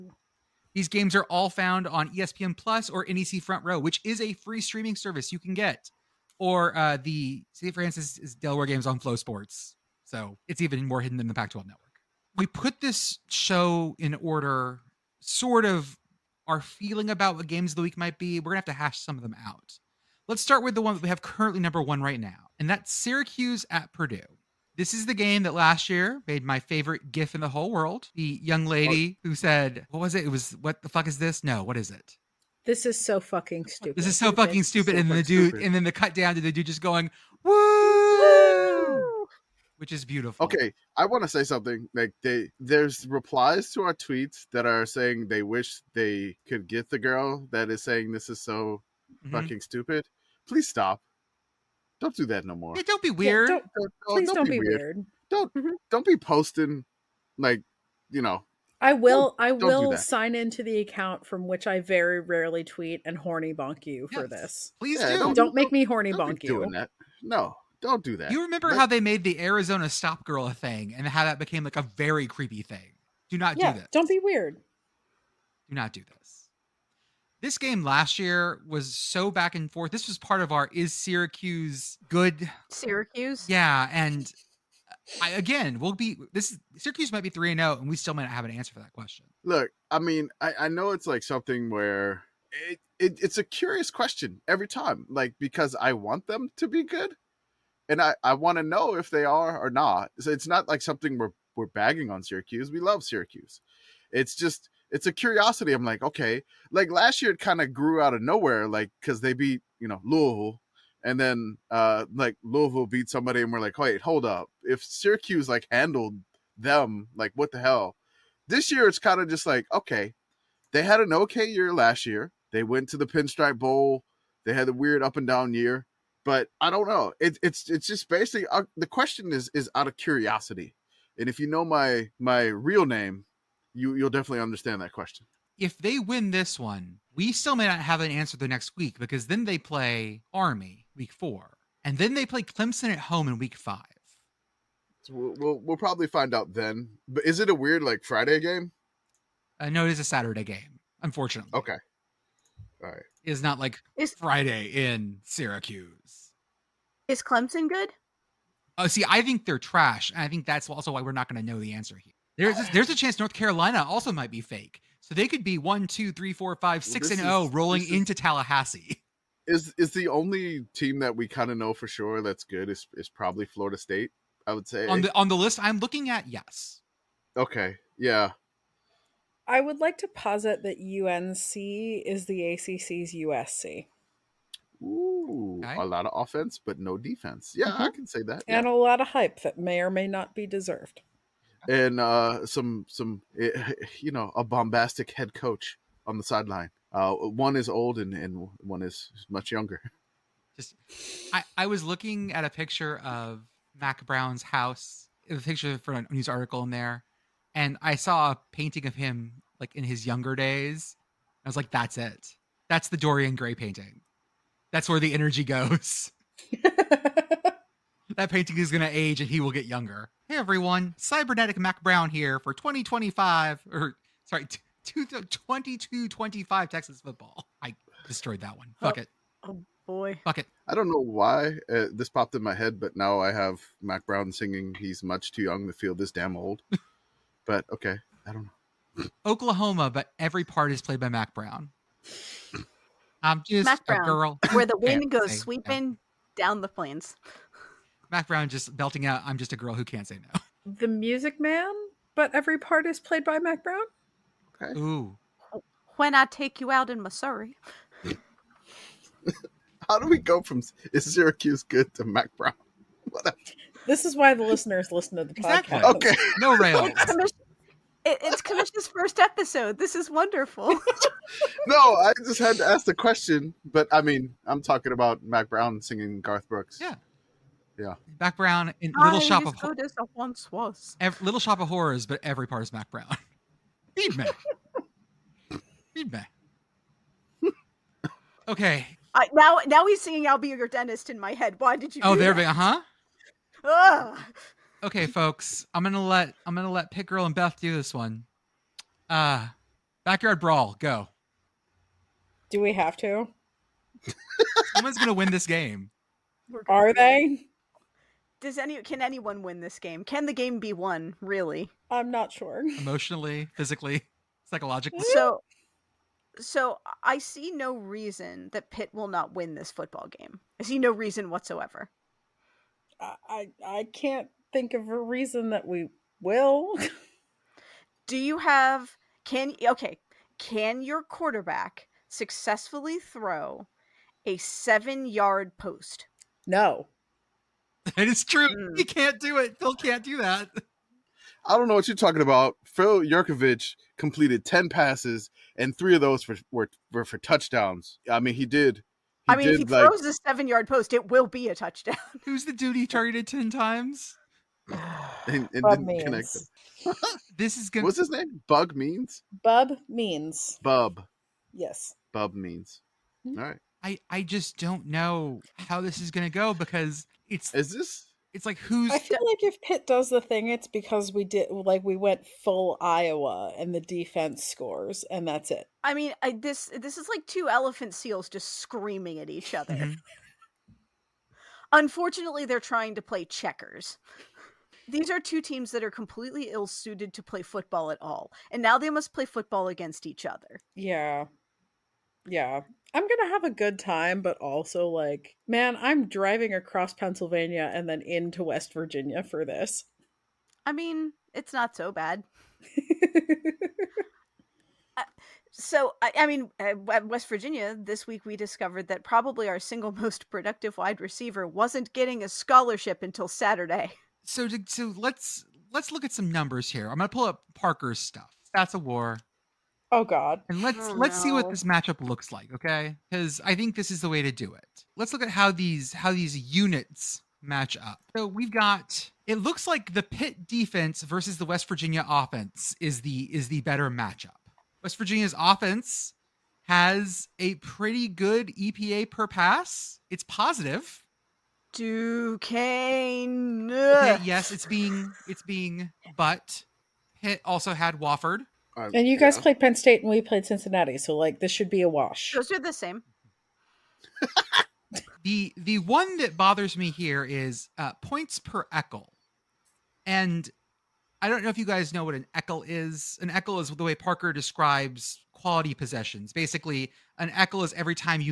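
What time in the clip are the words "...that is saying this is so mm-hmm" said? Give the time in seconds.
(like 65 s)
47 s.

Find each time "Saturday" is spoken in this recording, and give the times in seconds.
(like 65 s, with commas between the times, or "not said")
150 s, 413 s.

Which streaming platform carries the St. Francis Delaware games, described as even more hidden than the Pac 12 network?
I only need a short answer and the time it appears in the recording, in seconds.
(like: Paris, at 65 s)
FloSports, at 8 s.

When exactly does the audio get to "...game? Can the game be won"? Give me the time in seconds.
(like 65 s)
309 s.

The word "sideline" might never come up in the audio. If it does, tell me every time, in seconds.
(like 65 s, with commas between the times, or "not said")
196 s.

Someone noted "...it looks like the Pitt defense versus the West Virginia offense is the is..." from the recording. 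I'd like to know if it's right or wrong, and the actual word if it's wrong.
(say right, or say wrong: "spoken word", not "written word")
right.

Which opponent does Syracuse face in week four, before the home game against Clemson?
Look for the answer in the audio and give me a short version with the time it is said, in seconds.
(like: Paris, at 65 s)
Army, at 140 s.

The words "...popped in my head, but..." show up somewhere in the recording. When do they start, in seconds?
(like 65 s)
232 s.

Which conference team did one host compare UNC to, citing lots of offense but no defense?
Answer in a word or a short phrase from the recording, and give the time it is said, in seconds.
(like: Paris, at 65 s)
USC, at 183 s.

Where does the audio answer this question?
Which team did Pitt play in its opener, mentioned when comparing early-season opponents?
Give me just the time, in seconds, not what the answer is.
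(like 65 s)
447 s.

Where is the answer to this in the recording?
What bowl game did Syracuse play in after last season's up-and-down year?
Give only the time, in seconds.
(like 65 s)
123 s.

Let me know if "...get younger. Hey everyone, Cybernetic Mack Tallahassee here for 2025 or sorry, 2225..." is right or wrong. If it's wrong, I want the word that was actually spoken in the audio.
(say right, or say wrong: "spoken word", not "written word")
wrong: "Brown", not "Tallahassee".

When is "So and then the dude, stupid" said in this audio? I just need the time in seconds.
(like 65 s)
34 s.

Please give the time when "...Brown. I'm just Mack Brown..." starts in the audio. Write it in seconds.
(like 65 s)
241 s.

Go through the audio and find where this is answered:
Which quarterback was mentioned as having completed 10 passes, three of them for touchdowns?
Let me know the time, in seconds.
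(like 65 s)
342 s.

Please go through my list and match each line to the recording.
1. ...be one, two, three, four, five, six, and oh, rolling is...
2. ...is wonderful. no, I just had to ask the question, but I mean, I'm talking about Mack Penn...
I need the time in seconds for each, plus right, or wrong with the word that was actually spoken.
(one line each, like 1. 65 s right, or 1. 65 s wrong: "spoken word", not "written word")
1. 165 s right
2. 269 s wrong: "Brown", not "Penn".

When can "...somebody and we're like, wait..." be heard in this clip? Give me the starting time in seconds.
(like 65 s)
113 s.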